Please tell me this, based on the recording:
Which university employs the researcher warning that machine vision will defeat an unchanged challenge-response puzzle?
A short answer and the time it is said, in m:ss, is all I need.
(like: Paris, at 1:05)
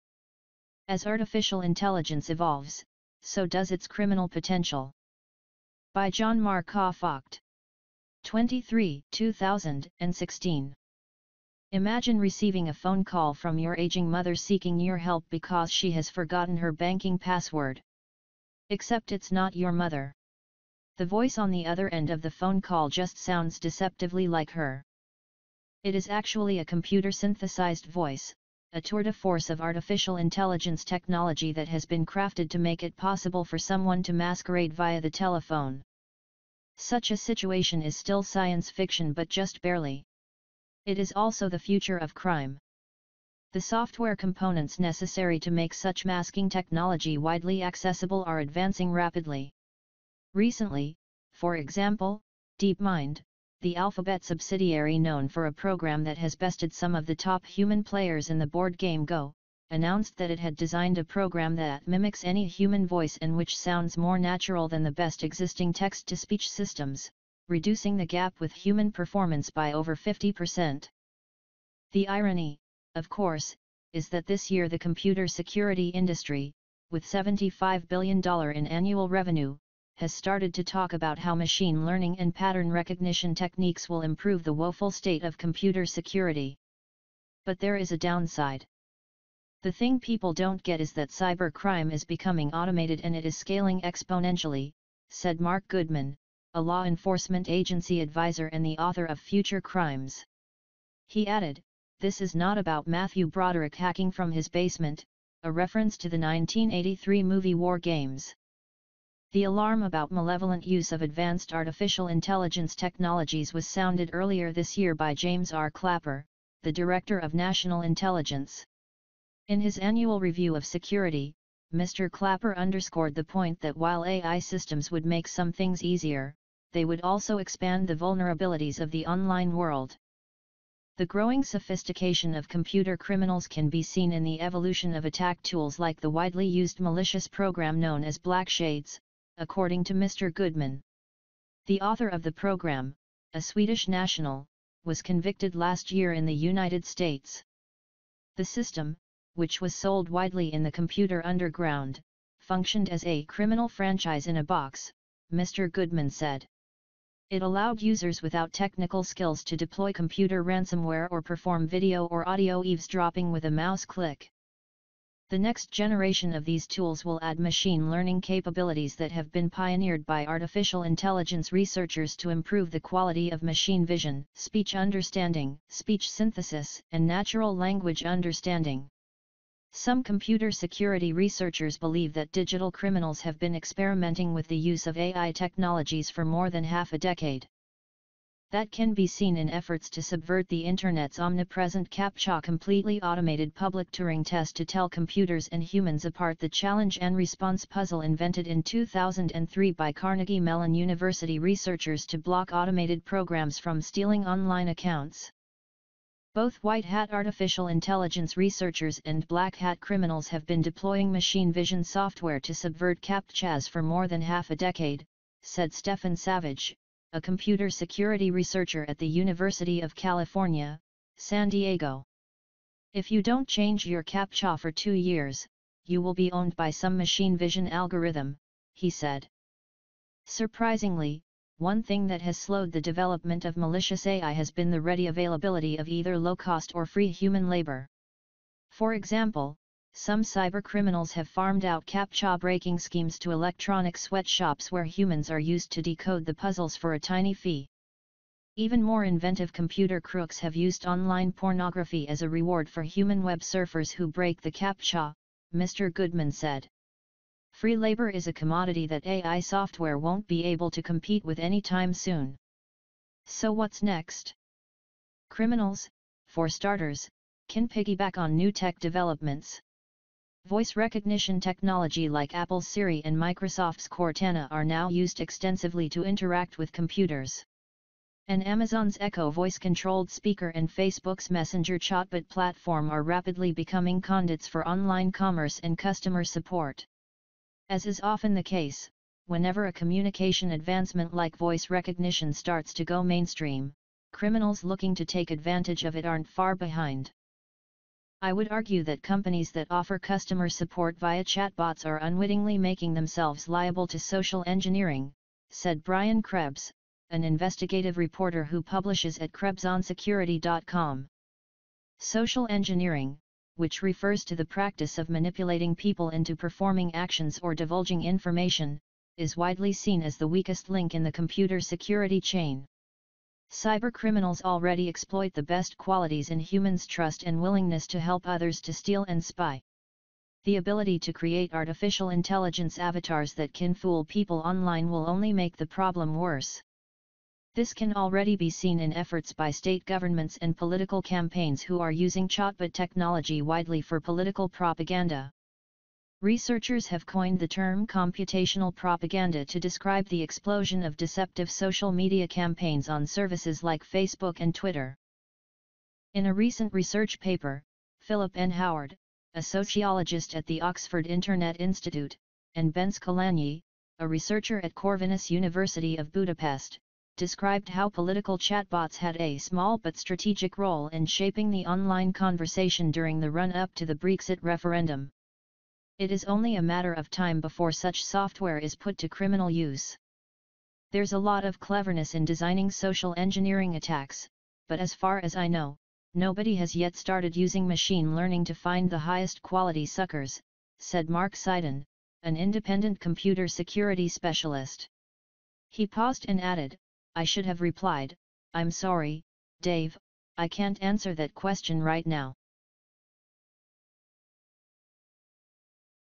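University of California, San Diego, at 3:39.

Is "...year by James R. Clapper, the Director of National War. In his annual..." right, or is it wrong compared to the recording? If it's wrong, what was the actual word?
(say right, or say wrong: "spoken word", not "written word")
wrong: "Intelligence", not "War".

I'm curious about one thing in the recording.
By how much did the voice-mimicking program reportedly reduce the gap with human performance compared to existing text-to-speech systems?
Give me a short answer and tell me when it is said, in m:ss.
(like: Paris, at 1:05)
over 50%, at 1:09.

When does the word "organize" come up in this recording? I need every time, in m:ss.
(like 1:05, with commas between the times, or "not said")
not said.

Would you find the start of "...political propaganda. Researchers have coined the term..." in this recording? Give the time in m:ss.
5:43.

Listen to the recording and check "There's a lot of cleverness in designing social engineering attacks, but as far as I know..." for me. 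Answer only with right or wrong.
right.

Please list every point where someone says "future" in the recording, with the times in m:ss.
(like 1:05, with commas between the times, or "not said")
0:41, 1:39.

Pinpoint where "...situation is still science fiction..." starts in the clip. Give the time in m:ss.
0:37.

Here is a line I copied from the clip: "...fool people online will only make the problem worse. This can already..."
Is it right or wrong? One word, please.
right.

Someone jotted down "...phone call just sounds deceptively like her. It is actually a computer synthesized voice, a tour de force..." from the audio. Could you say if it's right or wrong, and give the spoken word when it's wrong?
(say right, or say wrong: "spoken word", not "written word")
right.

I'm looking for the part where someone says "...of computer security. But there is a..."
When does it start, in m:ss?
1:25.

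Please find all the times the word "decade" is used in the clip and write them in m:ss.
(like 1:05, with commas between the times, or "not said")
3:06, 3:34.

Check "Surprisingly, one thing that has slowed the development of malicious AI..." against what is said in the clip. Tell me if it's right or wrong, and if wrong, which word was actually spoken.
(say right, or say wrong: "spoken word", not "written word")
right.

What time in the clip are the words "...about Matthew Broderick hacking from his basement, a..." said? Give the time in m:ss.
1:42.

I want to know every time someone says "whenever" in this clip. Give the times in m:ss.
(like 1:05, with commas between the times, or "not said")
4:49.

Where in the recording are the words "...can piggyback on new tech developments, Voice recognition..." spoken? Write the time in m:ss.
4:27.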